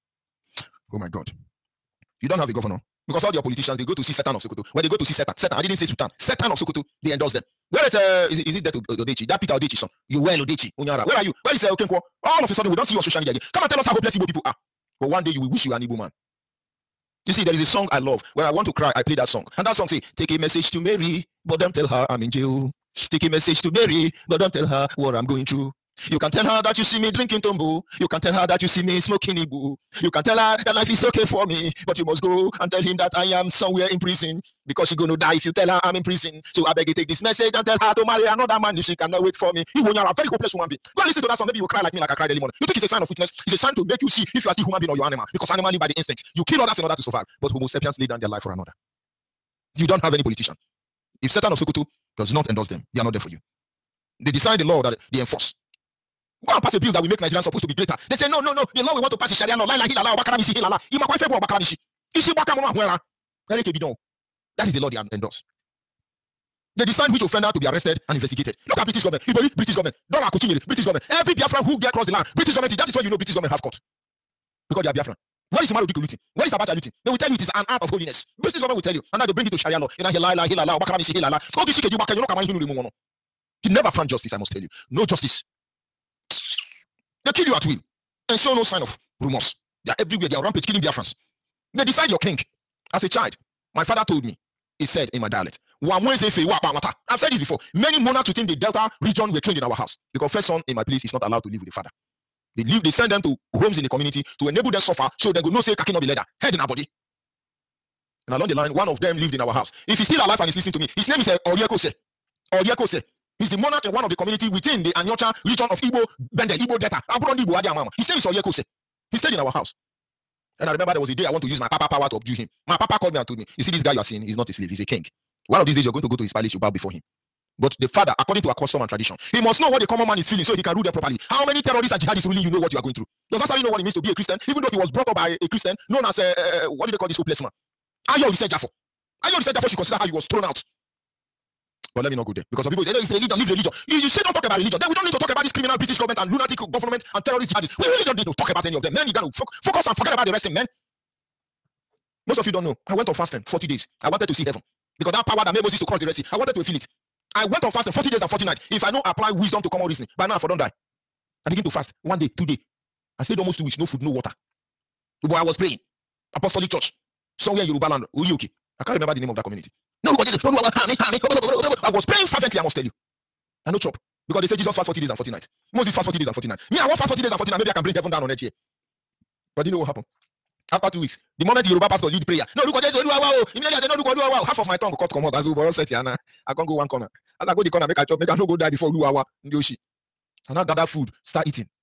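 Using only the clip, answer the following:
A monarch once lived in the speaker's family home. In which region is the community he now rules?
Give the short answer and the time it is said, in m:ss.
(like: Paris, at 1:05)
Aniocha, at 1:54.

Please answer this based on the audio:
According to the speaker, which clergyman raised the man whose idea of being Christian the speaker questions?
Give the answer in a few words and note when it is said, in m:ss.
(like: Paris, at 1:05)
Ayo Oritsejafor, at 2:18.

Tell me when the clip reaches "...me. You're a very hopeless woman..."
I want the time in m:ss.
0:39.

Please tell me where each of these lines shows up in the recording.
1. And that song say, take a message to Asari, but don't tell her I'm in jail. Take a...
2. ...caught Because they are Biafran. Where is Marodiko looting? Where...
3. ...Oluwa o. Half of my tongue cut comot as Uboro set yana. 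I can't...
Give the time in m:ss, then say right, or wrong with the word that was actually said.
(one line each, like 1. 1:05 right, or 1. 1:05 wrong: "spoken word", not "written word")
1. 0:19 wrong: "Mary", not "Asari"
2. 1:13 right
3. 3:04 right.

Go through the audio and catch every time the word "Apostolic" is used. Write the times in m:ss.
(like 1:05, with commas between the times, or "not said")
2:46.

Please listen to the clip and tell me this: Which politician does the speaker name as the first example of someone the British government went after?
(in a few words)
Ibori.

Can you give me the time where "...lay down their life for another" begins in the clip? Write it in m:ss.
0:47.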